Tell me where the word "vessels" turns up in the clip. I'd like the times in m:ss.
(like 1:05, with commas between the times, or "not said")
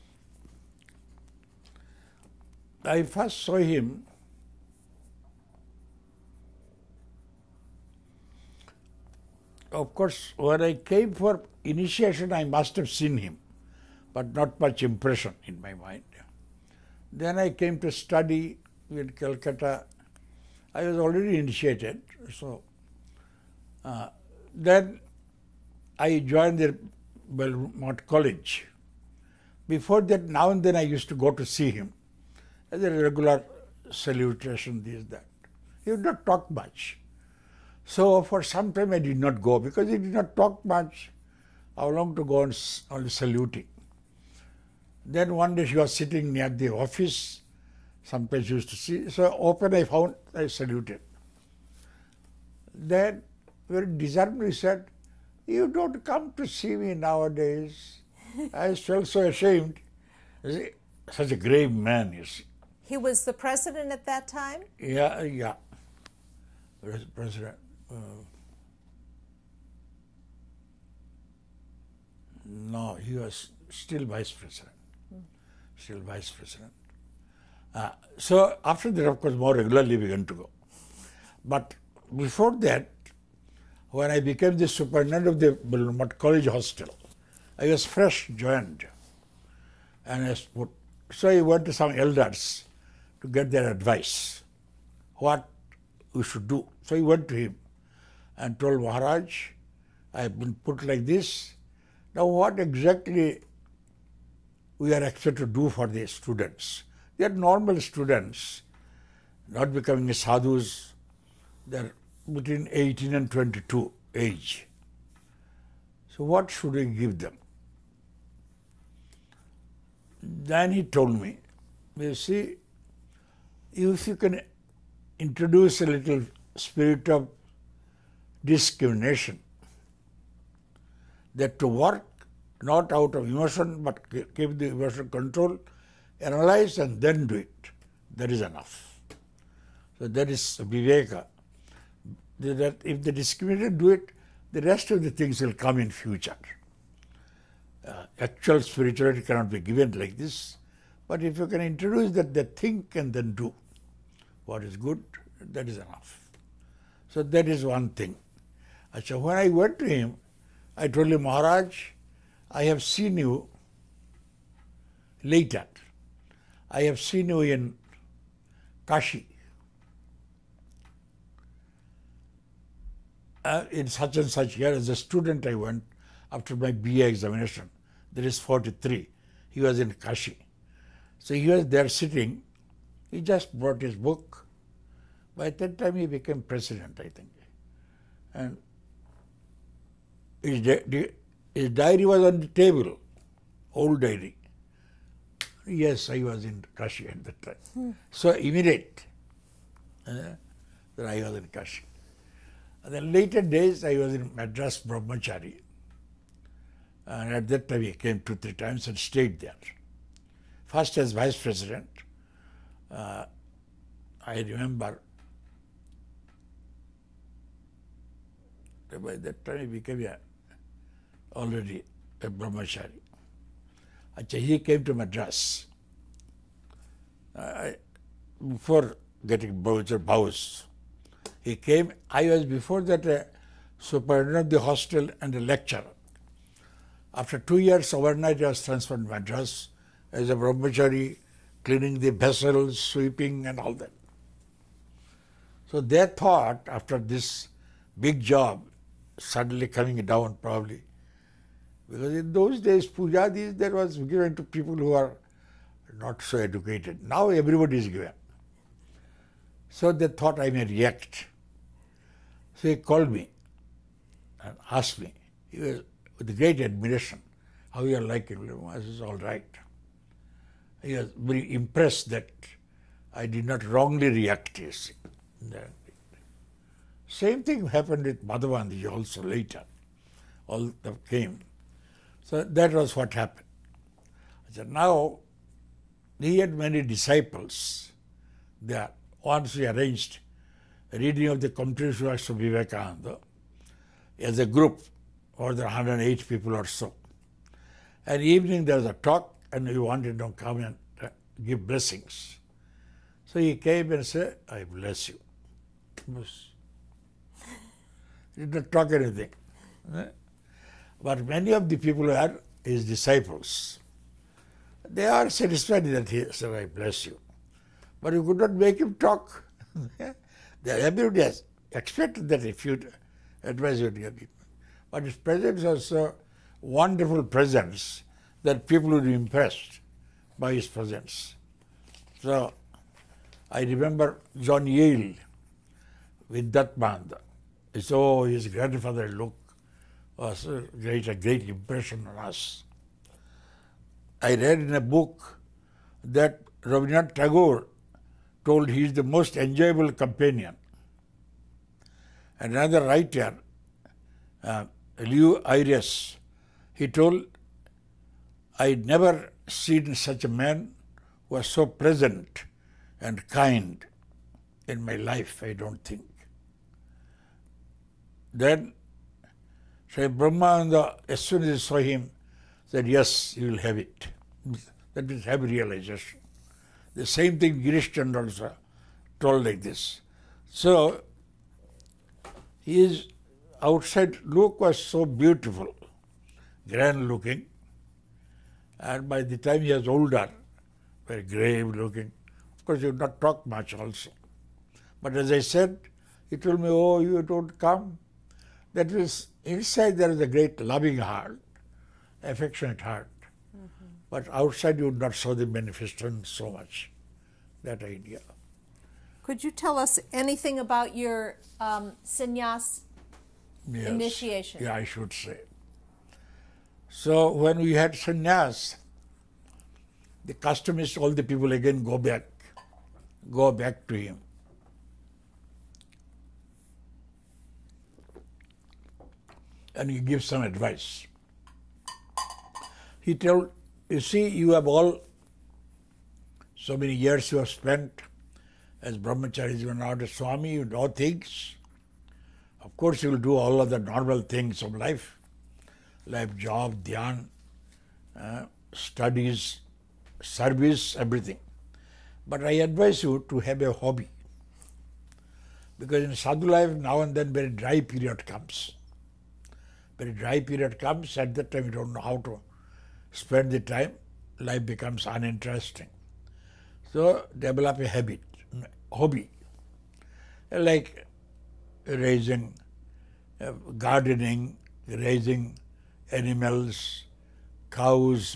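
4:02.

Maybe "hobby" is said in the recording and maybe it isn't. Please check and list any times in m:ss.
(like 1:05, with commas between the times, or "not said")
7:33, 7:48.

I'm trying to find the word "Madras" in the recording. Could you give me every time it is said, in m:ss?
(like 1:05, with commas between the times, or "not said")
3:24, 3:44, 3:59.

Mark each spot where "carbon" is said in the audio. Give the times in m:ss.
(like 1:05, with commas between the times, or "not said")
not said.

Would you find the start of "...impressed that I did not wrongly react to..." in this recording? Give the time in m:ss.
4:31.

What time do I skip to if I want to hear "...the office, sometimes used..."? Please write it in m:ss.
0:46.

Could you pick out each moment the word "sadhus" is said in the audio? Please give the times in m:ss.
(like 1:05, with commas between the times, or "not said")
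1:50, 7:36.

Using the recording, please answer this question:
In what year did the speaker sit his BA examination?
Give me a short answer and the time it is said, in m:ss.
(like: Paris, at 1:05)
1943, at 2:58.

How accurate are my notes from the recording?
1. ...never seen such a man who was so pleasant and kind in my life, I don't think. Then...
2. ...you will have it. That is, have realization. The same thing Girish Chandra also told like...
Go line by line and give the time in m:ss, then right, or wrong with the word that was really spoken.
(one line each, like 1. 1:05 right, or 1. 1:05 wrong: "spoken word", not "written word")
1. 5:58 right
2. 6:13 right.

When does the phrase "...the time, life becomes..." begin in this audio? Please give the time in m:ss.
7:43.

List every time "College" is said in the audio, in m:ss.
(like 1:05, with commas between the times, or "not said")
0:28, 1:26.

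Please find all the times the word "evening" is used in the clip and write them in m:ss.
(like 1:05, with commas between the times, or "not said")
4:58.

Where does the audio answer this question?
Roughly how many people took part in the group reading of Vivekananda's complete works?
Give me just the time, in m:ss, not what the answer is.
4:55.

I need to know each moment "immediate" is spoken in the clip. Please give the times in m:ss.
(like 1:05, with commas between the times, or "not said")
3:18.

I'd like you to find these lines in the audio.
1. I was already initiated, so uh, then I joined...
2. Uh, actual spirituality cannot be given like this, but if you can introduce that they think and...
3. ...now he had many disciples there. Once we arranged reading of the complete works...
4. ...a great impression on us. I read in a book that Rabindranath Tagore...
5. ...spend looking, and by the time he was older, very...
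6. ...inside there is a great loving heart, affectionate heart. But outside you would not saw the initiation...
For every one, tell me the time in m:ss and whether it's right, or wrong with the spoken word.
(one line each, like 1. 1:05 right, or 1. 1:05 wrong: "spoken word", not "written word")
1. 0:20 right
2. 2:27 right
3. 4:44 right
4. 5:41 right
5. 6:26 wrong: "grand", not "spend"
6. 6:39 wrong: "manifestation", not "initiation".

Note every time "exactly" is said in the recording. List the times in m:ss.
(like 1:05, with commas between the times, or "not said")
1:42.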